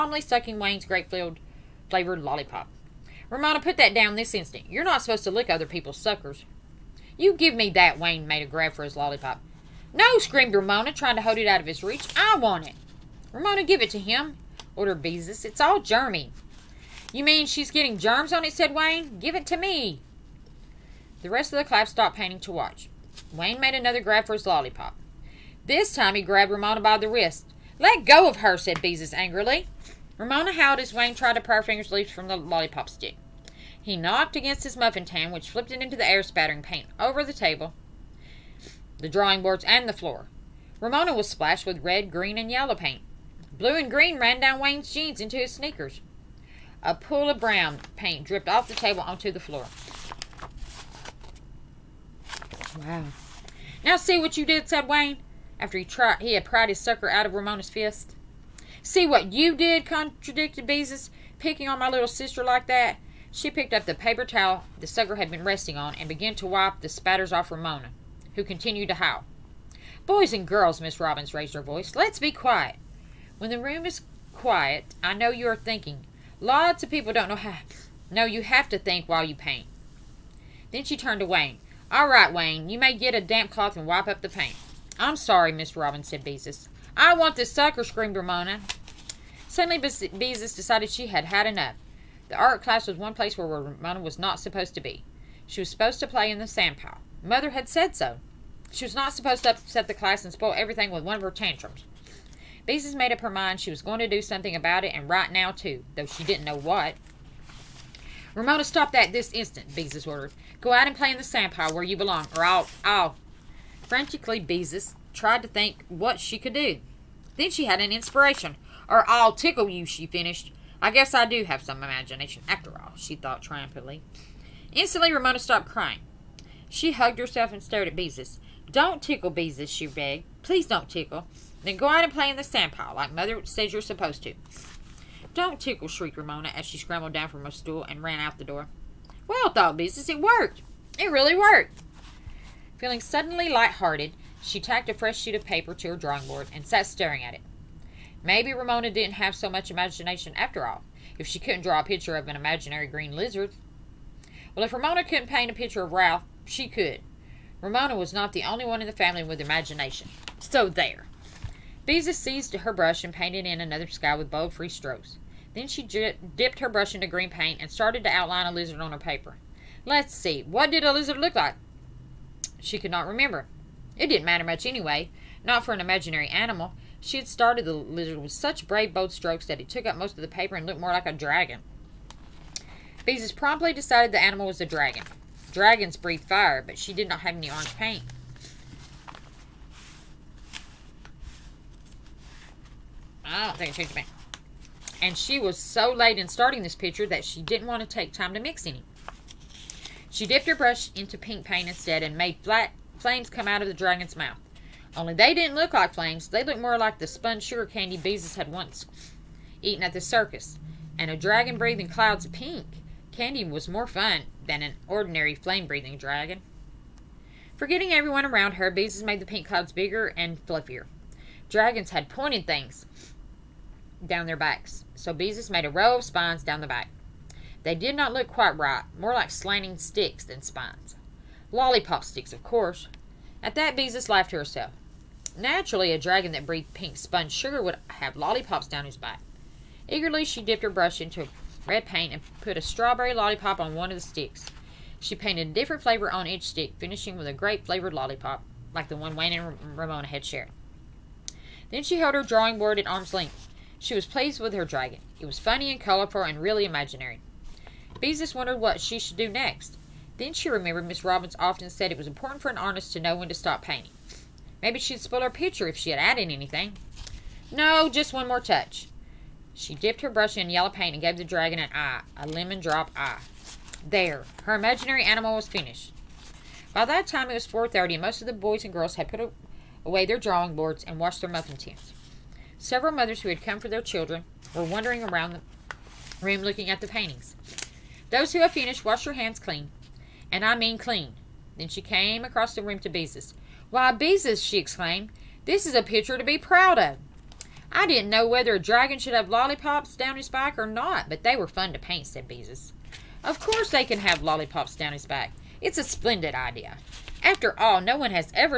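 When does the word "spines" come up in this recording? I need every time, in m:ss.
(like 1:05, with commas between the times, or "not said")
3:46, 3:50.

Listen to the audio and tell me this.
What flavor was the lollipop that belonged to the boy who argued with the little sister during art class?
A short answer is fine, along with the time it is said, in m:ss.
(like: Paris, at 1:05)
Grape, at 0:00.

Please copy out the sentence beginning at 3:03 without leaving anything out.
Beezus promptly decided the animal was a dragon.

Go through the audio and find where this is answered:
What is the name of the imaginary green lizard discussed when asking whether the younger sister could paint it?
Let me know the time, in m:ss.
2:35.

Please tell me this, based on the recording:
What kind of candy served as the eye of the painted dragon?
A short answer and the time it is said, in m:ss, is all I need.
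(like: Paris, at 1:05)
Lemon drop, at 4:32.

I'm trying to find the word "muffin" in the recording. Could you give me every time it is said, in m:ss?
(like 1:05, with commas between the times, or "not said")
0:34, 4:41.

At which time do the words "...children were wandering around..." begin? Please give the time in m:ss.
4:43.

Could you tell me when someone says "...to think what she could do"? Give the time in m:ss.
1:55.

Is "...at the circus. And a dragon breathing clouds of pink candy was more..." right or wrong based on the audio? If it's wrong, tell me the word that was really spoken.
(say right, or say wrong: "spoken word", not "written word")
right.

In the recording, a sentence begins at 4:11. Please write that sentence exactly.
Then she held her drawing board at arm's length.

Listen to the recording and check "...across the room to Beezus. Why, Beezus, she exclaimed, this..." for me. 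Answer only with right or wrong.
right.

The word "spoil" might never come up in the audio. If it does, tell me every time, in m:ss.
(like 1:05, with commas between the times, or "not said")
1:40, 4:24.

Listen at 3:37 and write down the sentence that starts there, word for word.
Forgetting everyone around her, Beezus made the pink clouds bigger and fluffier.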